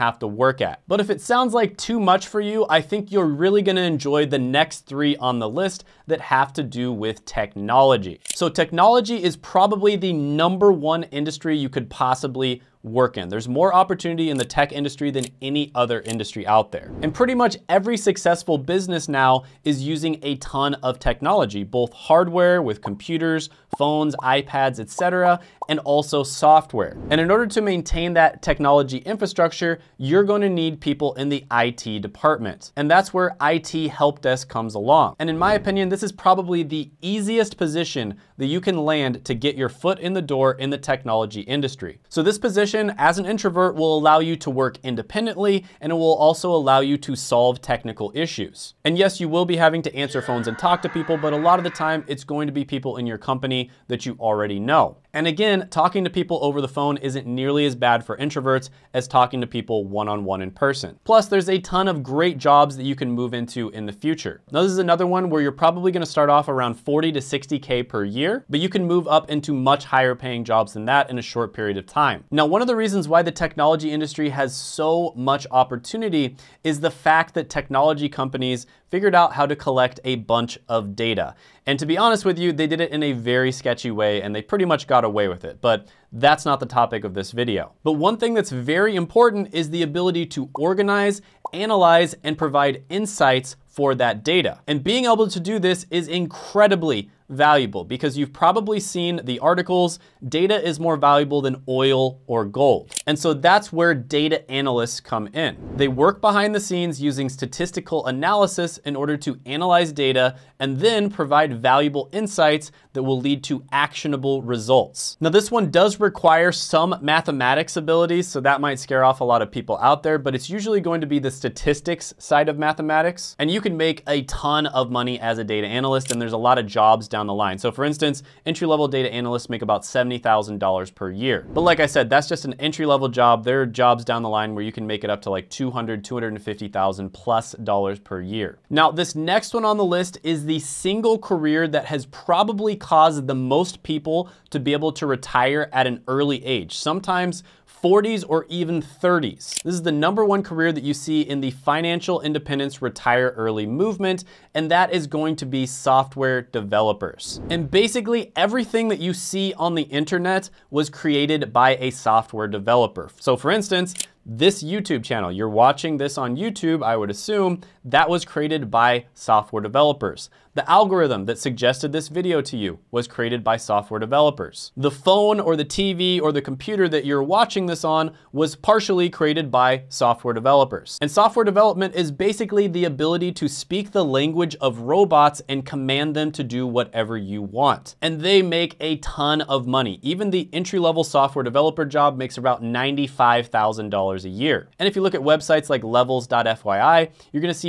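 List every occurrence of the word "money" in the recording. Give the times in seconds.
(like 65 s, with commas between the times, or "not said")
124 s, 189 s.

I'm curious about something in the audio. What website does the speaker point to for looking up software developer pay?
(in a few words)
levels.fyi.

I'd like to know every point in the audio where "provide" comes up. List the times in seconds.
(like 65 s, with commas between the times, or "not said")
92 s, 111 s.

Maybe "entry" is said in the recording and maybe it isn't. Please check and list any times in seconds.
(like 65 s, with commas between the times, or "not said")
128 s, 132 s, 190 s.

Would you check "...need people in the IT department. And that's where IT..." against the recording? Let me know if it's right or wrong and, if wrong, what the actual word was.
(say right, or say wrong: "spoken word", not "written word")
right.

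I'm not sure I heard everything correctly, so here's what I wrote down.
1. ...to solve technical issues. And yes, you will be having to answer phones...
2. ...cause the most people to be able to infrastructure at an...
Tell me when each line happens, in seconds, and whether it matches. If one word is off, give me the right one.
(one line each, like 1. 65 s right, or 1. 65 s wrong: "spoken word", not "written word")
1. 46 s right
2. 142 s wrong: "retire", not "infrastructure".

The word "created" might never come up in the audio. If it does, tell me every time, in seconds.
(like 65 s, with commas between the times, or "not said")
160 s, 168 s, 173 s, 179 s.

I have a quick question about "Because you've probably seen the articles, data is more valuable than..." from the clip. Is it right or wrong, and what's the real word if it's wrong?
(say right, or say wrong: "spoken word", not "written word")
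right.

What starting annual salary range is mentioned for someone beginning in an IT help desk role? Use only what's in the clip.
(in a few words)
40 to 60K.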